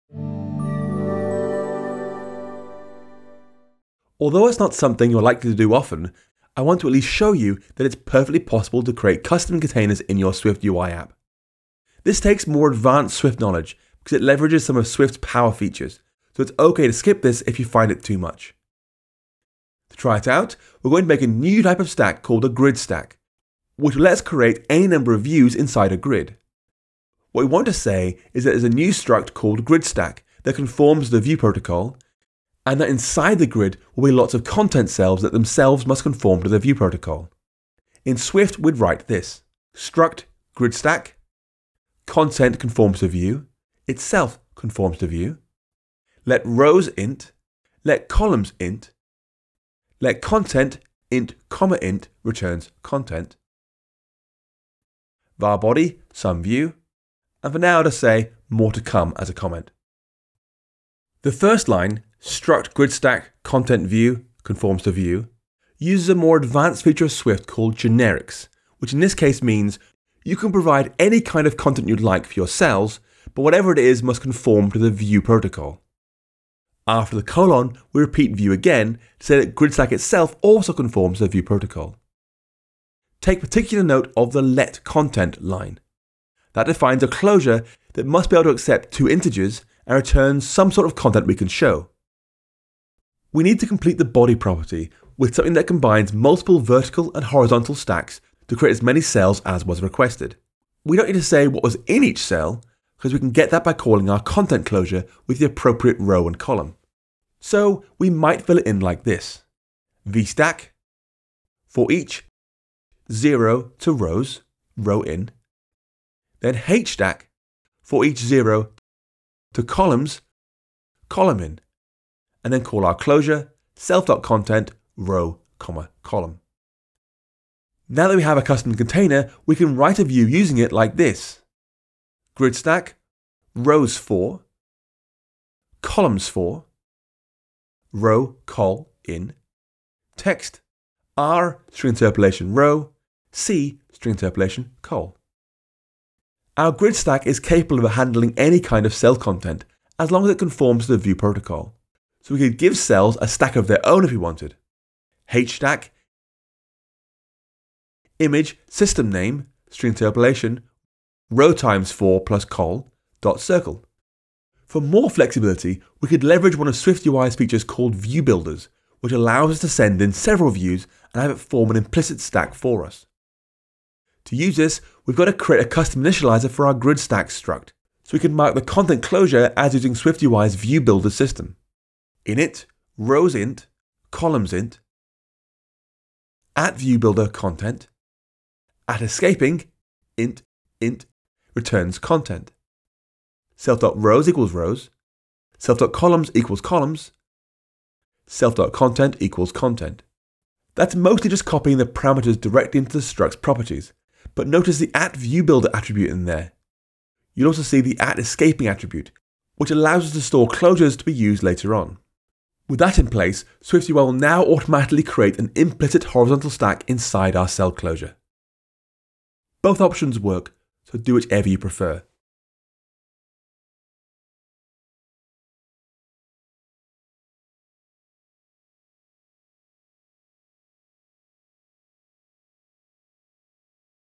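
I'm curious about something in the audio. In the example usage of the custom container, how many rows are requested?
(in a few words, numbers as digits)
4.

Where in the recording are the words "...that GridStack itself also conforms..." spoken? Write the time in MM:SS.
01:19.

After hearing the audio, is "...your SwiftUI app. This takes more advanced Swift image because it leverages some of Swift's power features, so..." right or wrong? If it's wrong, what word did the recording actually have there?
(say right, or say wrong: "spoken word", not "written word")
wrong: "knowledge", not "image".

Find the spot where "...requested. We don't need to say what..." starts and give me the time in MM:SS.
01:39.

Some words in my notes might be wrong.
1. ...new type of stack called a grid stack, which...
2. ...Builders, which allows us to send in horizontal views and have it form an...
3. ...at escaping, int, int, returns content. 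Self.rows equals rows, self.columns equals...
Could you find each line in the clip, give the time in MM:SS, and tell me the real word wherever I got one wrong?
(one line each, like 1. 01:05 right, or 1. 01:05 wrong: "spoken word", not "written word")
1. 00:21 right
2. 02:48 wrong: "several", not "horizontal"
3. 03:08 right.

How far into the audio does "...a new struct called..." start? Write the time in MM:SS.
00:28.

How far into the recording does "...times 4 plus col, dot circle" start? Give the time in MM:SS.
02:41.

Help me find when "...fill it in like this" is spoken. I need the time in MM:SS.
01:48.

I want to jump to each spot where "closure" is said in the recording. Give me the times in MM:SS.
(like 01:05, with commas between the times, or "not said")
01:27, 01:44, 02:02, 02:59, 03:30, 03:37.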